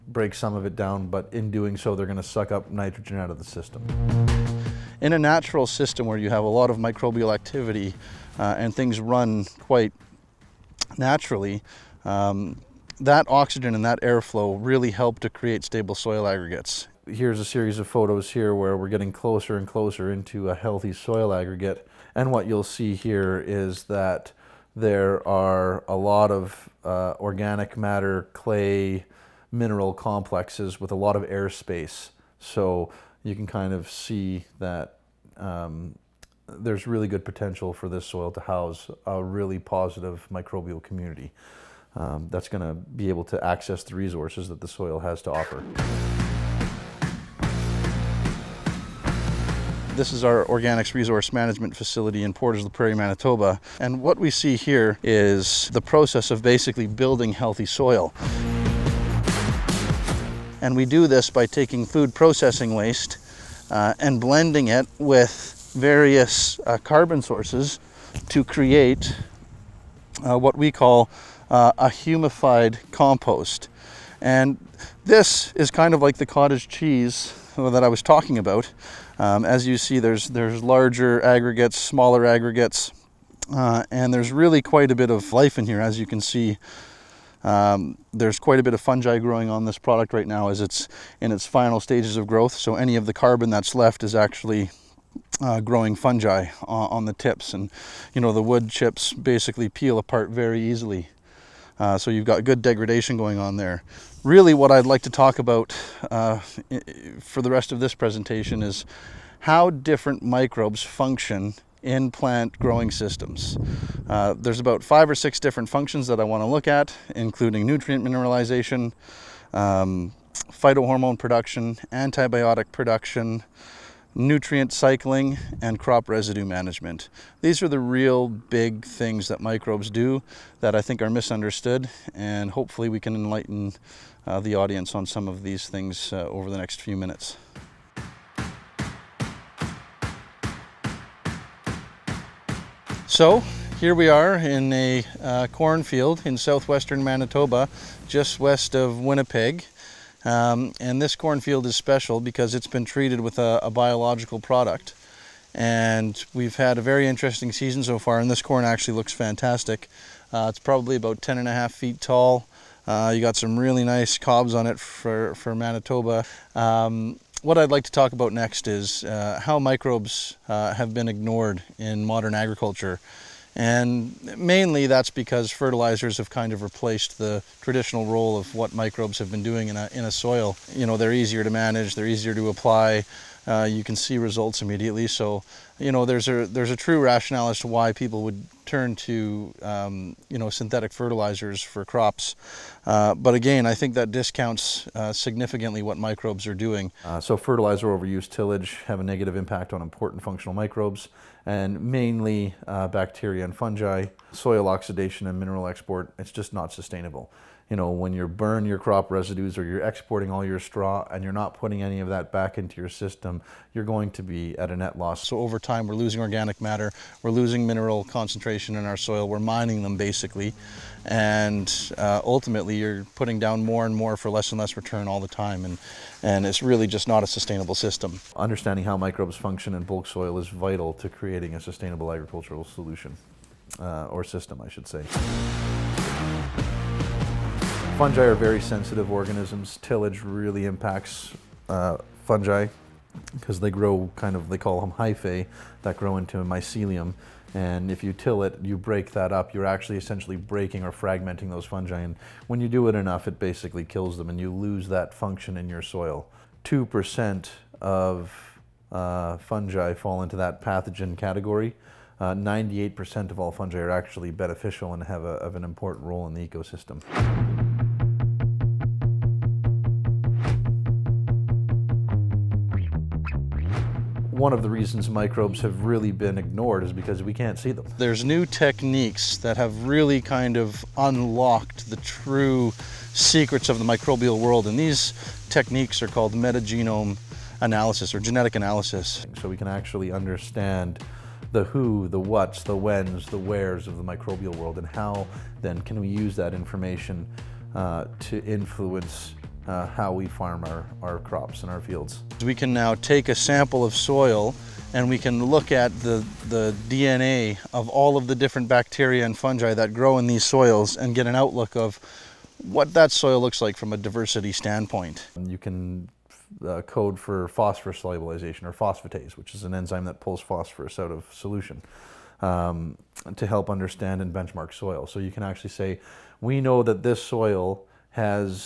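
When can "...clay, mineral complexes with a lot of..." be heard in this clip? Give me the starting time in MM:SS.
00:28.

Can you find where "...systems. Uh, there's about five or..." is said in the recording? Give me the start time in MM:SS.
01:52.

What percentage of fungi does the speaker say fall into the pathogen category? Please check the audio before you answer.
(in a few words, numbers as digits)
2%.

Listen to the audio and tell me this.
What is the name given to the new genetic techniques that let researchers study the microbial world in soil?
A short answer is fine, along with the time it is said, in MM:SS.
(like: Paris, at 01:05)
metagenome analysis, at 04:46.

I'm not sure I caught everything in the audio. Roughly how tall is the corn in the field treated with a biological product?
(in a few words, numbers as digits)
10 and a half feet.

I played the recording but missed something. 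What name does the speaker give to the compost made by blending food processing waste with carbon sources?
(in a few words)
humified compost.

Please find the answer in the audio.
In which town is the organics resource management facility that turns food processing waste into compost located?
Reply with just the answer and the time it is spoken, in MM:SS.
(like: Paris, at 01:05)
Portage la Prairie, Manitoba, at 00:52.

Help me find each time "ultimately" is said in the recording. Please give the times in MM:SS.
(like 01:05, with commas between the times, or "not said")
03:42.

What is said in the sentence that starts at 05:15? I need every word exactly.
You can uh, code for phosphorus solubilization or phosphatase, which is an enzyme that pulls phosphorus out of solution.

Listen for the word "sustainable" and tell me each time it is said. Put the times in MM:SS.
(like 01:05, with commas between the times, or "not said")
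03:26, 03:47, 03:51.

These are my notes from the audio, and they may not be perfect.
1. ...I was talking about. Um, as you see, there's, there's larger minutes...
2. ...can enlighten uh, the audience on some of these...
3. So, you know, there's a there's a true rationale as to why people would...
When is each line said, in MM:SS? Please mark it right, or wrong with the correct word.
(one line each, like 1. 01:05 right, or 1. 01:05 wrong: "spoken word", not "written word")
1. 01:17 wrong: "aggregates", not "minutes"
2. 02:12 right
3. 03:05 right.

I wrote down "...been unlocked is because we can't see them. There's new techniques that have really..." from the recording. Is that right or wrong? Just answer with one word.
wrong.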